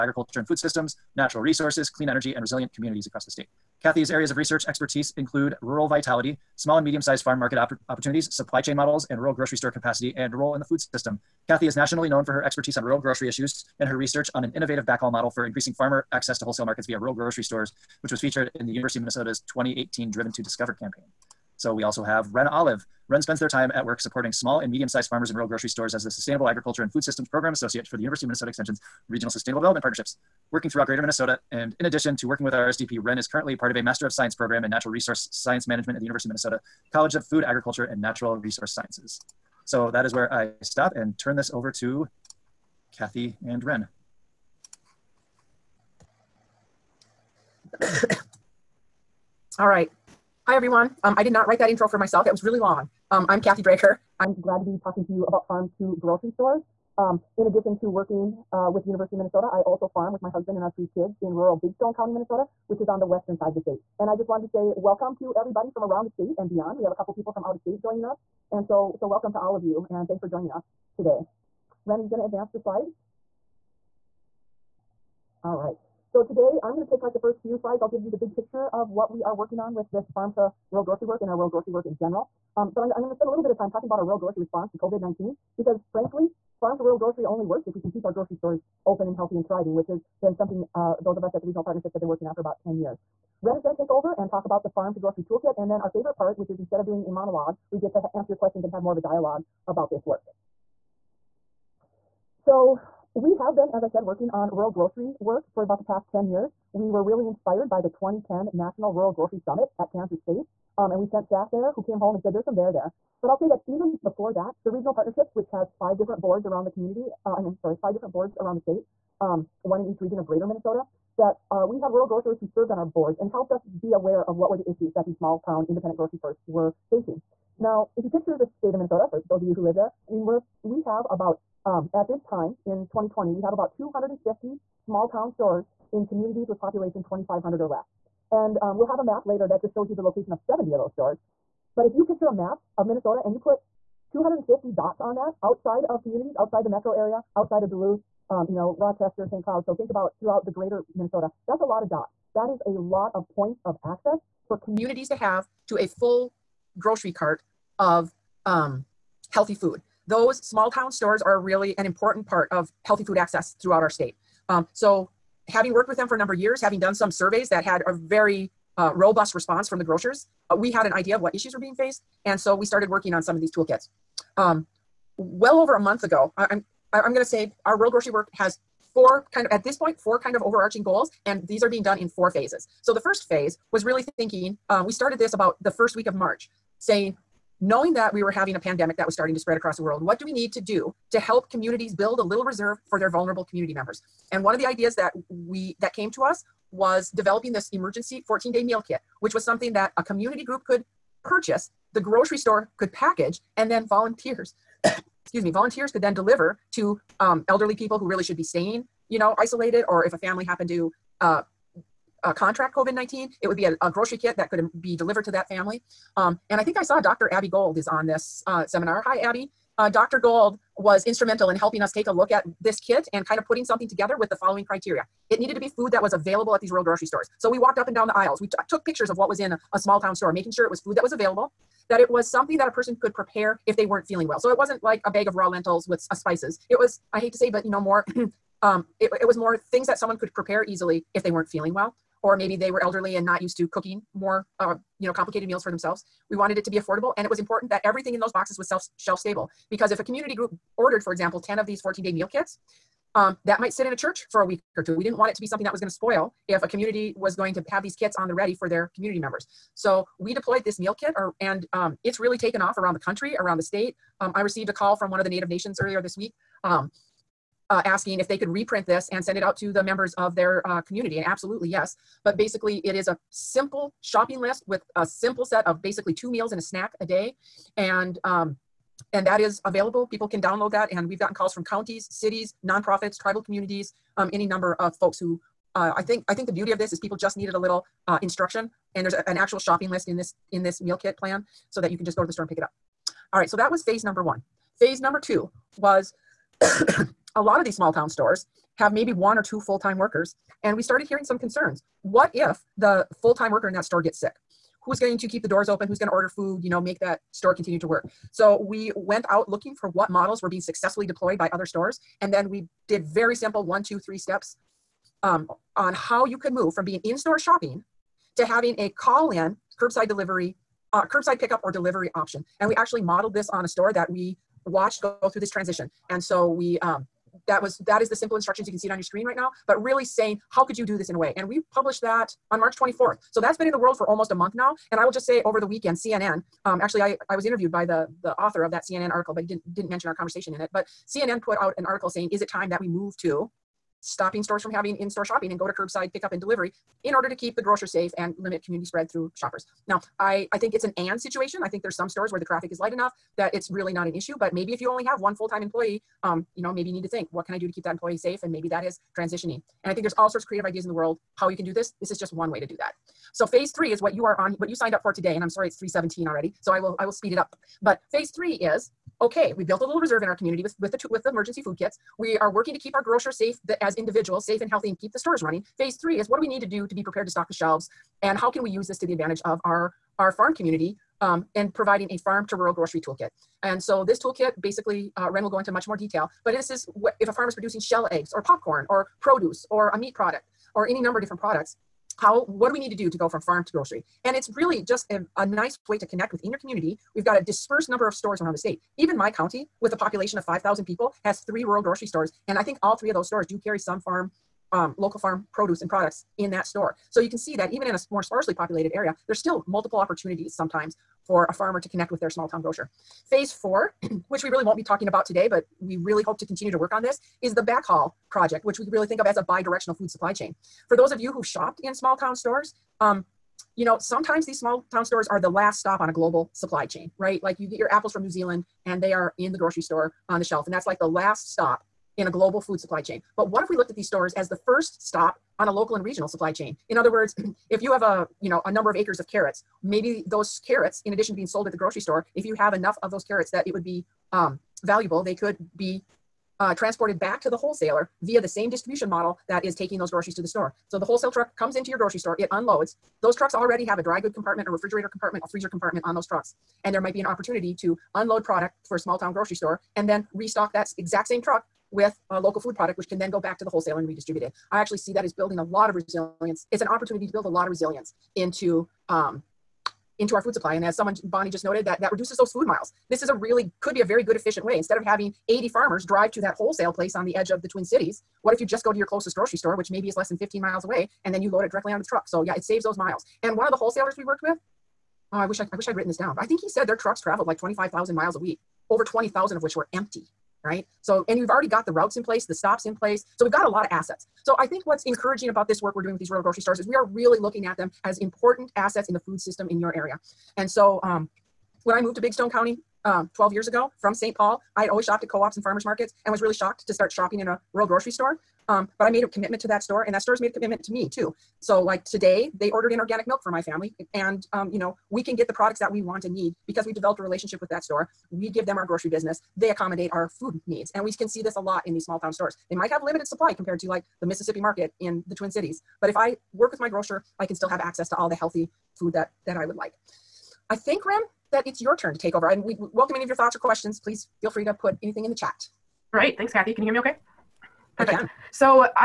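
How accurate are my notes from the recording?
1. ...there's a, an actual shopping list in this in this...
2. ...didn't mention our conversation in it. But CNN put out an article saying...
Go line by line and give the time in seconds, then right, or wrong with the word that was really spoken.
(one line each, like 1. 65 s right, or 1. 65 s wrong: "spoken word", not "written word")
1. 289 s right
2. 339 s right.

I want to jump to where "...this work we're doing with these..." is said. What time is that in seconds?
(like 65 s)
495 s.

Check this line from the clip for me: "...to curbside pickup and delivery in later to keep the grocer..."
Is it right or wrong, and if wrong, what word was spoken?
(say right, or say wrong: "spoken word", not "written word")
wrong: "order", not "later".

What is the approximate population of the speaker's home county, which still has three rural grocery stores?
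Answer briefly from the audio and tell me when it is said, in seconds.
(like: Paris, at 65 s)
5,000, at 400 s.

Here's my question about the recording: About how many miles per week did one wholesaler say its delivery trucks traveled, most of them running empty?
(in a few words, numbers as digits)
25,000.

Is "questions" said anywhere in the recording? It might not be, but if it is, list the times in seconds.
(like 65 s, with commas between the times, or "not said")
98 s, 533 s.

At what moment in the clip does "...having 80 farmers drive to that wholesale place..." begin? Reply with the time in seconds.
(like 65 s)
475 s.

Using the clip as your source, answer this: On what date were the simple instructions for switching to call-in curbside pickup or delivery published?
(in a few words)
March 24th.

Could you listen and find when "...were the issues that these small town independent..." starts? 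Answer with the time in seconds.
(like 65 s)
124 s.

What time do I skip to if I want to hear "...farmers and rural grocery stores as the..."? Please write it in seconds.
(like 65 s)
25 s.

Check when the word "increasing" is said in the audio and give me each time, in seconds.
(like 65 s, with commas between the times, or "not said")
15 s.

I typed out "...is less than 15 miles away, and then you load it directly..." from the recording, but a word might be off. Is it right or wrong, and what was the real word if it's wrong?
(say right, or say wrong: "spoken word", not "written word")
right.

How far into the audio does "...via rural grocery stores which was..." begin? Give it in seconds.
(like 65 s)
16 s.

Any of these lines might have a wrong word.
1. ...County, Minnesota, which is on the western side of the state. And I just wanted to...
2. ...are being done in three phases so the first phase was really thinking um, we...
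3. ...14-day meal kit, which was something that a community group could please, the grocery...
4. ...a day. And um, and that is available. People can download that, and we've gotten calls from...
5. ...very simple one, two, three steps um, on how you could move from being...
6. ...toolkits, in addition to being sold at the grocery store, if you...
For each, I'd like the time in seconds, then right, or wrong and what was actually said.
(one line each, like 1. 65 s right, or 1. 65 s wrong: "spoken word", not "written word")
1. 61 s right
2. 181 s wrong: "four", not "three"
3. 198 s wrong: "purchase", not "please"
4. 276 s right
5. 313 s right
6. 440 s wrong: "carrots", not "toolkits".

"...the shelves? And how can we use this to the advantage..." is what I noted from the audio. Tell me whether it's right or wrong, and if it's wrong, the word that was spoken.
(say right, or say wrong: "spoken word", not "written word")
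right.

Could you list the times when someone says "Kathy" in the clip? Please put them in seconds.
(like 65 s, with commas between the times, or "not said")
3 s, 11 s, 42 s, 53 s, 536 s.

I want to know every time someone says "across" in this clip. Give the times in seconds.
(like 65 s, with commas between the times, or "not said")
3 s, 189 s.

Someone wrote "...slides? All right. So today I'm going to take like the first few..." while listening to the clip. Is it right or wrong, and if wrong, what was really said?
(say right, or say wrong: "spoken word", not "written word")
right.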